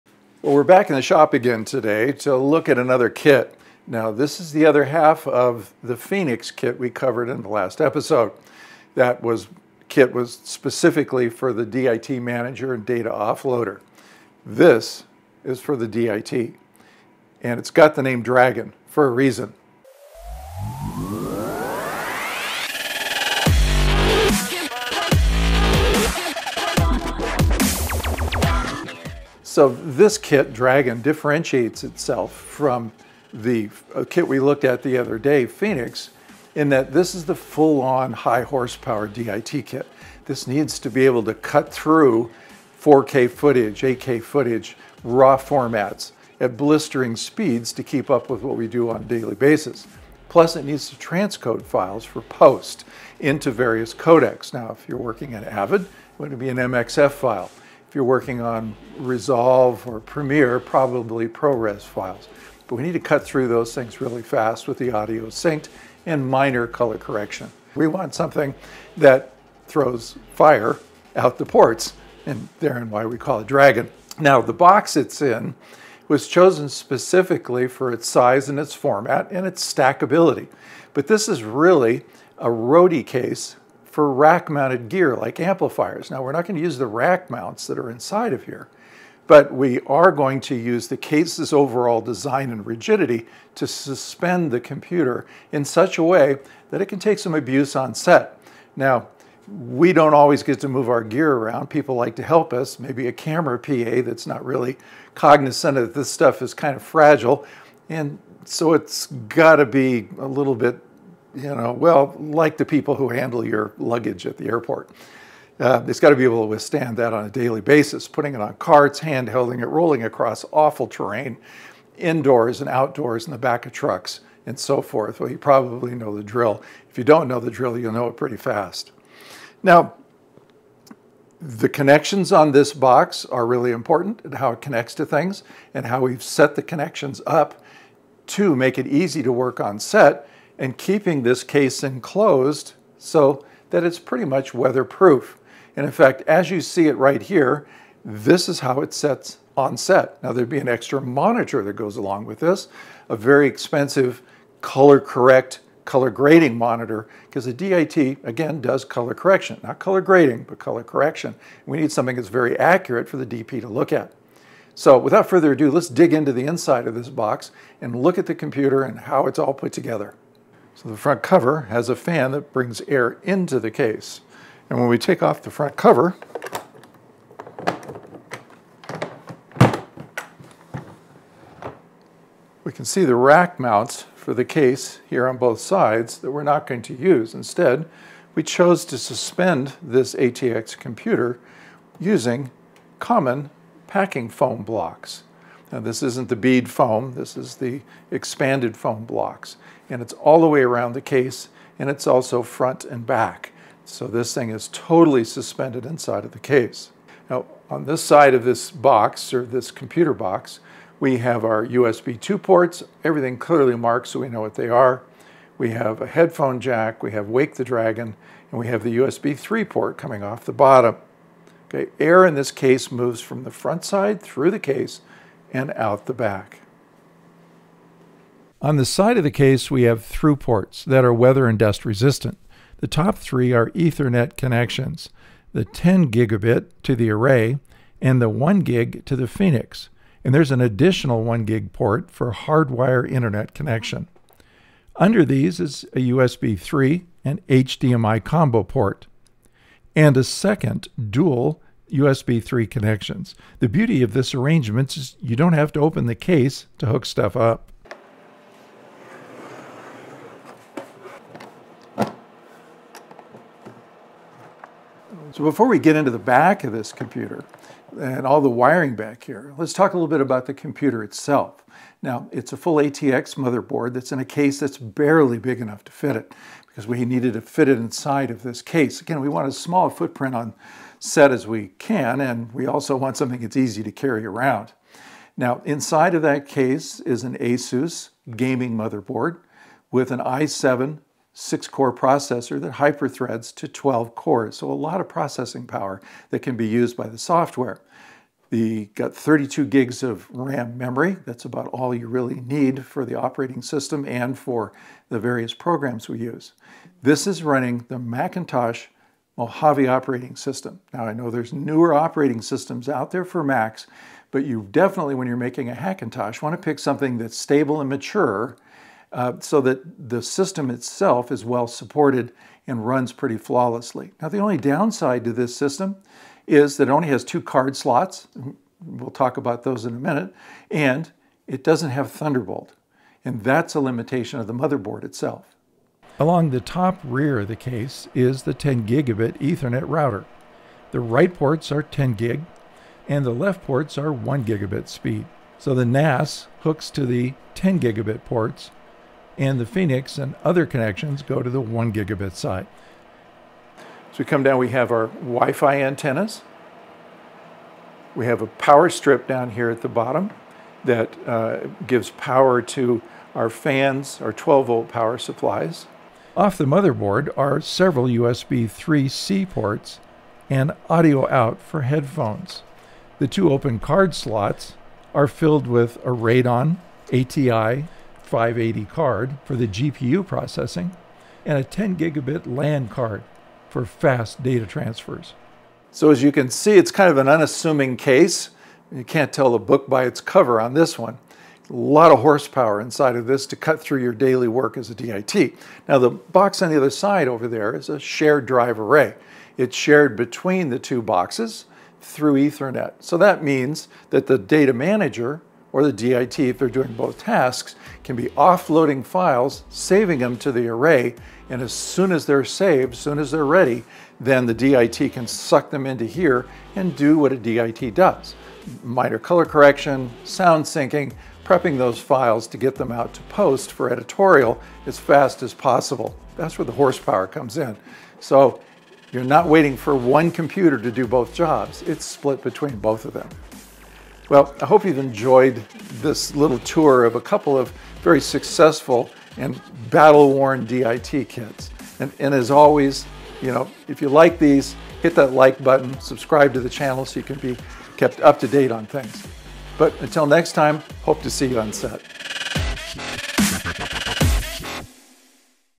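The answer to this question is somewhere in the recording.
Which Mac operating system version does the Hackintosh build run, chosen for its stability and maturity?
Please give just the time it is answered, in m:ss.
5:09.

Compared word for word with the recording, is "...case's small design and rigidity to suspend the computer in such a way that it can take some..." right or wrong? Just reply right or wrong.
wrong.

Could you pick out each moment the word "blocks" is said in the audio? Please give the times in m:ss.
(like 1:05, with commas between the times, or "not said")
3:14, 3:19.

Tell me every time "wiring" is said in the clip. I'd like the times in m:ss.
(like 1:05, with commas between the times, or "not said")
4:28.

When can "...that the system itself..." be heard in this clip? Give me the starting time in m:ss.
5:19.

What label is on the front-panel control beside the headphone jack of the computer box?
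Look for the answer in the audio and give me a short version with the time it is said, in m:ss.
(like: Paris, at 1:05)
Wake the Dragon, at 3:37.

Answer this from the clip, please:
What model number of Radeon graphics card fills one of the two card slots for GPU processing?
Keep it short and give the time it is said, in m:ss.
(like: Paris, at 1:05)
580, at 6:18.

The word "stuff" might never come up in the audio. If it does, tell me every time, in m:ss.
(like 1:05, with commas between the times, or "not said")
1:46, 4:17.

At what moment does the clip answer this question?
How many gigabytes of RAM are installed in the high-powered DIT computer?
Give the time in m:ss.
4:59.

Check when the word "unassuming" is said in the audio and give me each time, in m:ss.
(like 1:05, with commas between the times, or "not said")
6:27.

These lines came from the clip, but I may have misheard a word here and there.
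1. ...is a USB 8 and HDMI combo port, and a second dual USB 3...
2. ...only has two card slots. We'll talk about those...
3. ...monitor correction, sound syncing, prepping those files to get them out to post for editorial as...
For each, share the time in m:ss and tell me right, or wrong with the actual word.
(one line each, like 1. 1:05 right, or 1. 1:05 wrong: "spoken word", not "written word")
1. 4:05 wrong: "3", not "8"
2. 5:26 right
3. 6:59 wrong: "color", not "monitor".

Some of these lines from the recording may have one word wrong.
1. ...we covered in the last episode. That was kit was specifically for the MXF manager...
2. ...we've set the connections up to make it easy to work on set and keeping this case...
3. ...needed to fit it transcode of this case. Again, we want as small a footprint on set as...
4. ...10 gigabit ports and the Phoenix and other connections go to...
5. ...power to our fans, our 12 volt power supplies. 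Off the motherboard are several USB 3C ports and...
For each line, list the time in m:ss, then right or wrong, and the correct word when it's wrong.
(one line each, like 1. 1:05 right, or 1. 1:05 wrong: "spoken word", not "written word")
1. 0:06 wrong: "DIT", not "MXF"
2. 2:16 right
3. 4:37 wrong: "inside", not "transcode"
4. 5:47 right
5. 6:02 right.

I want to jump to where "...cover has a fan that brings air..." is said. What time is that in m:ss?
2:51.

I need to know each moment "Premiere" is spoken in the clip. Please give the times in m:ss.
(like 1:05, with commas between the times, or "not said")
0:59.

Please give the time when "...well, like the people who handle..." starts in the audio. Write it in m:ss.
1:51.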